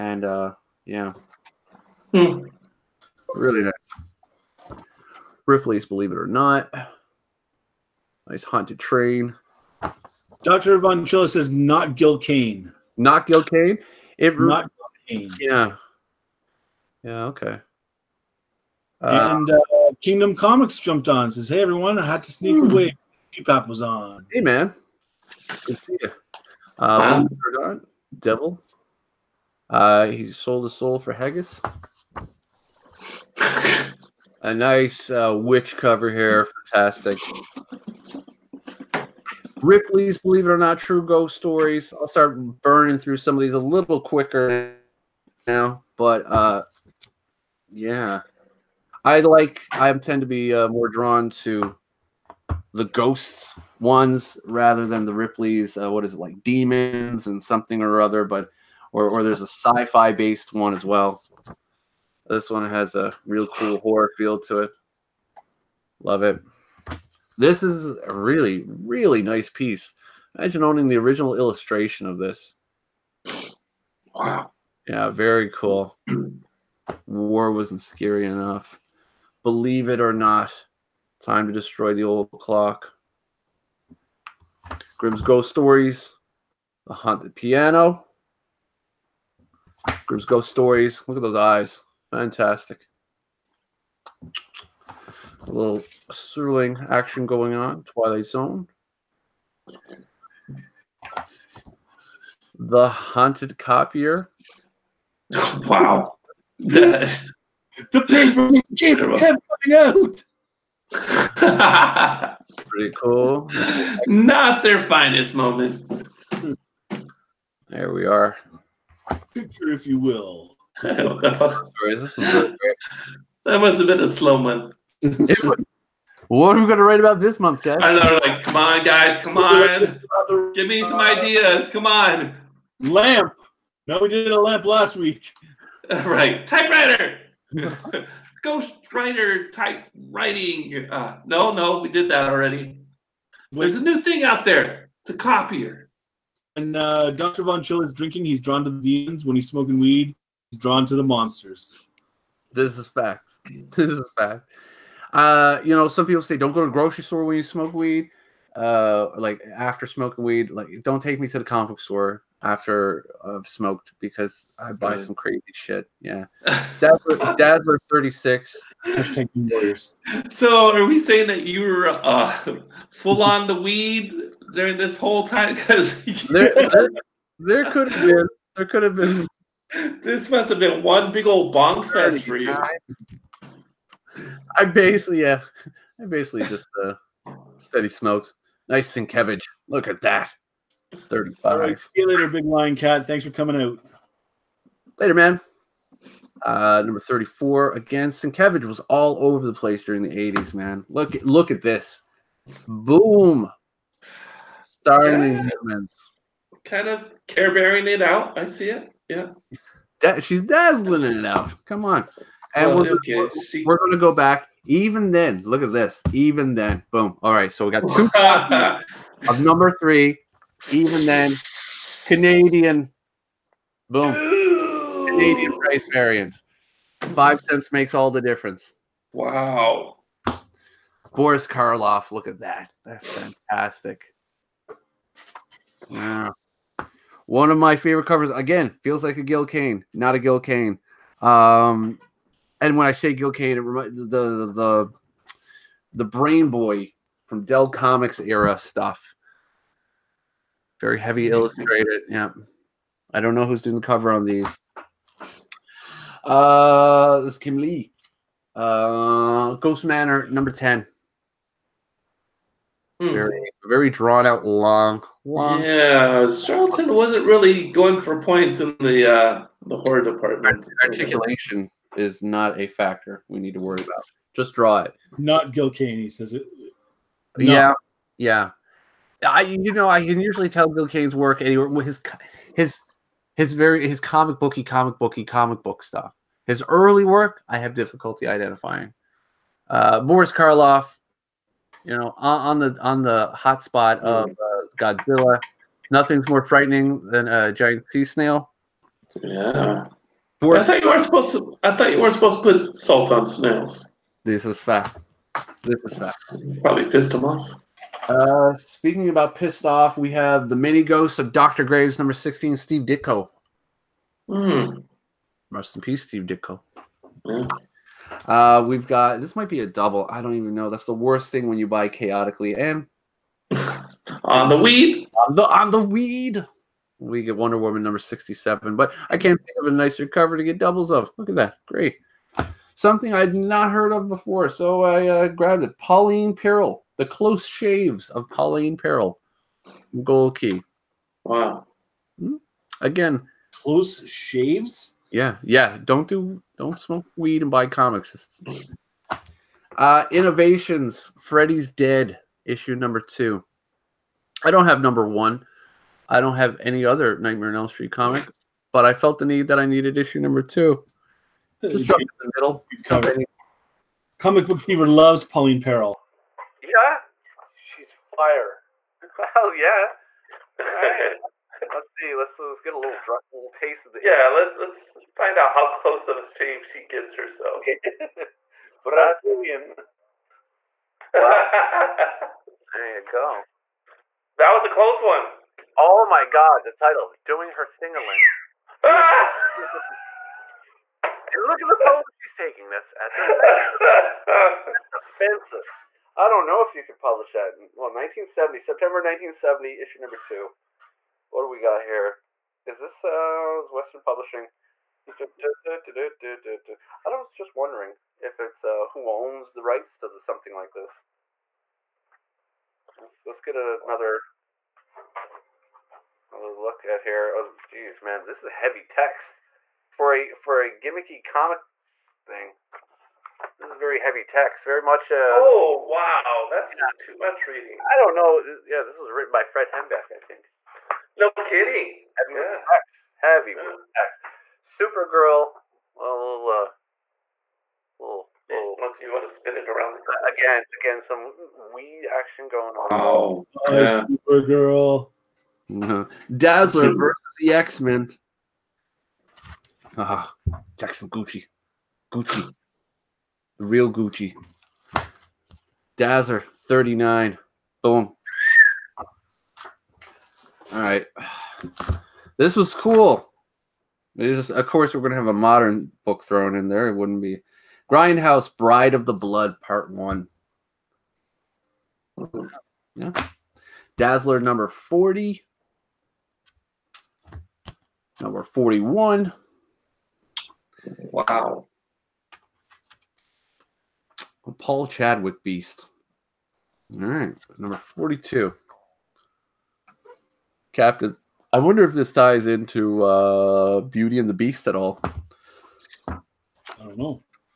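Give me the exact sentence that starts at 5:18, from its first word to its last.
Uh, we've got this might be a double.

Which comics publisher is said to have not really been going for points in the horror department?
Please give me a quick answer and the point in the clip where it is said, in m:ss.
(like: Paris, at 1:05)
Charlton, at 4:26.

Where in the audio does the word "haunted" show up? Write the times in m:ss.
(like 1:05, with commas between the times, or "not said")
0:08, 1:26, 1:42.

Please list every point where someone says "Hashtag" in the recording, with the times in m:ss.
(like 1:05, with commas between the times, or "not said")
2:48.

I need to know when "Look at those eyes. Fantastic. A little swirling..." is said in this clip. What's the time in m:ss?
1:31.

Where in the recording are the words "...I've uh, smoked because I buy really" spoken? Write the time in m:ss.
2:43.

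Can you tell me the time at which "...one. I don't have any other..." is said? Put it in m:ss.
5:55.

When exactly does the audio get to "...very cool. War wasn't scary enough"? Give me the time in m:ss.
1:15.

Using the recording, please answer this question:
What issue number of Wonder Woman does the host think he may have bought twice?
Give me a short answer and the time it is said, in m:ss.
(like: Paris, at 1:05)
67, at 5:27.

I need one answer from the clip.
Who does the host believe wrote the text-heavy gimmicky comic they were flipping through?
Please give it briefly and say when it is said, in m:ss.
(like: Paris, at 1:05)
Fred Hembeck, at 7:09.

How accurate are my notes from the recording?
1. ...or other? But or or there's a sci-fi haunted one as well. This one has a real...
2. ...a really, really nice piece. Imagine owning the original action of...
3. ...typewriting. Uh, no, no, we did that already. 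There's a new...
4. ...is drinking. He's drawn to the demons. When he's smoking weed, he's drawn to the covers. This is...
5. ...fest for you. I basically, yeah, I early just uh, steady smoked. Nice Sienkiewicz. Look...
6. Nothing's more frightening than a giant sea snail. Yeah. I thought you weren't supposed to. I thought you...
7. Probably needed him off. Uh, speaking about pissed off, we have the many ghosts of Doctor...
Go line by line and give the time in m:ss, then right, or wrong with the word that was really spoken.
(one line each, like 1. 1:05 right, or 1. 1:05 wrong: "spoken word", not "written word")
1. 0:57 wrong: "based", not "haunted"
2. 1:08 wrong: "illustration", not "action"
3. 2:19 right
4. 2:27 wrong: "monsters", not "covers"
5. 3:01 wrong: "basically", not "early"
6. 4:55 right
7. 5:06 wrong: "pissed", not "needed".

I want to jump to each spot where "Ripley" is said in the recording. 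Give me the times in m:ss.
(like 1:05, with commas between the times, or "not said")
0:05, 0:39, 0:55.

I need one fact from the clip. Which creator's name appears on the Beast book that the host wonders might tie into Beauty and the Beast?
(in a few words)
Paul Chadwick.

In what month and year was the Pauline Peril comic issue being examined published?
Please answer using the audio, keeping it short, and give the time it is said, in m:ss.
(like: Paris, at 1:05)
September 1970, at 6:38.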